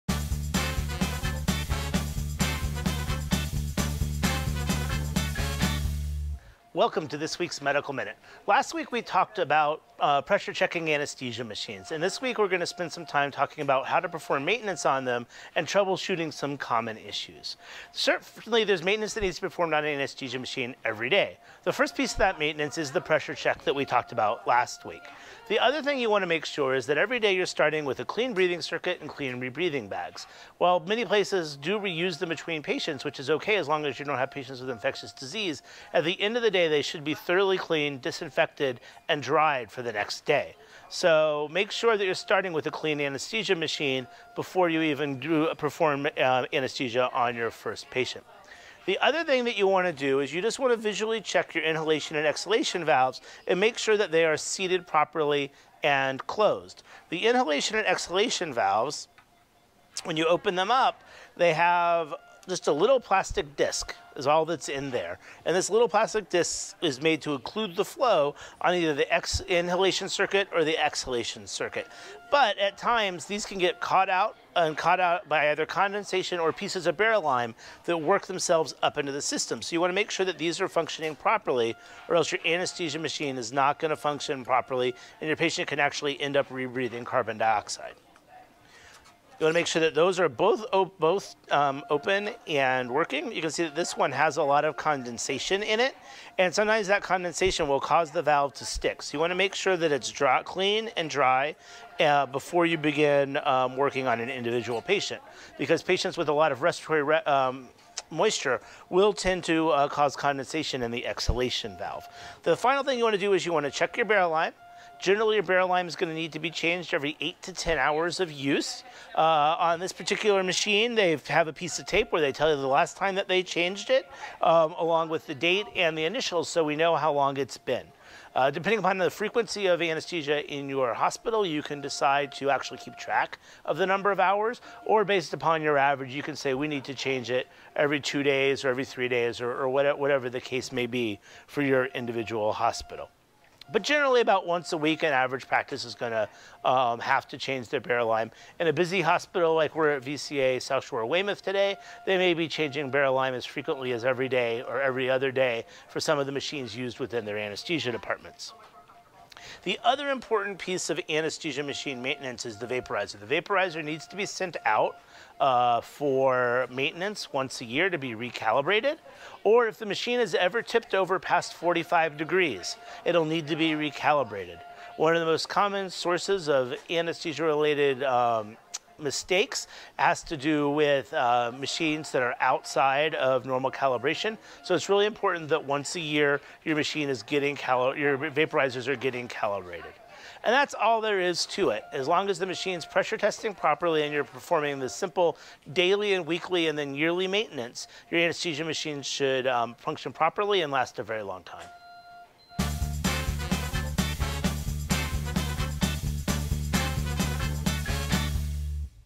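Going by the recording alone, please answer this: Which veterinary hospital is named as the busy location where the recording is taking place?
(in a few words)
VCA South Shore Weymouth.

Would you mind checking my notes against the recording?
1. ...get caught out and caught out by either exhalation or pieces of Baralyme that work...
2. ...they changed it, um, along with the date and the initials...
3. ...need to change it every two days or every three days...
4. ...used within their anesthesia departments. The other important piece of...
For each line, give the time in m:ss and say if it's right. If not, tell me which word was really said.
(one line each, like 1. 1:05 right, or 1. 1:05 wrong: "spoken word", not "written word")
1. 1:13 wrong: "condensation", not "exhalation"
2. 2:03 right
3. 2:16 right
4. 2:36 right.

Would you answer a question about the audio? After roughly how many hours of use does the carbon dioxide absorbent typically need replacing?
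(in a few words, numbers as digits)
8 to 10 hours.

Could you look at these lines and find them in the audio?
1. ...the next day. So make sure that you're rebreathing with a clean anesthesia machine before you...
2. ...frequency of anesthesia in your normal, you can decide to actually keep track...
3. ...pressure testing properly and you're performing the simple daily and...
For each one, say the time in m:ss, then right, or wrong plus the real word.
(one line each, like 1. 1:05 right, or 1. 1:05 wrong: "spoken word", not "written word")
1. 0:39 wrong: "starting", not "rebreathing"
2. 2:09 wrong: "hospital", not "normal"
3. 3:12 right.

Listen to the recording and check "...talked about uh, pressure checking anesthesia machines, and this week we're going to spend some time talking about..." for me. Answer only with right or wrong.
right.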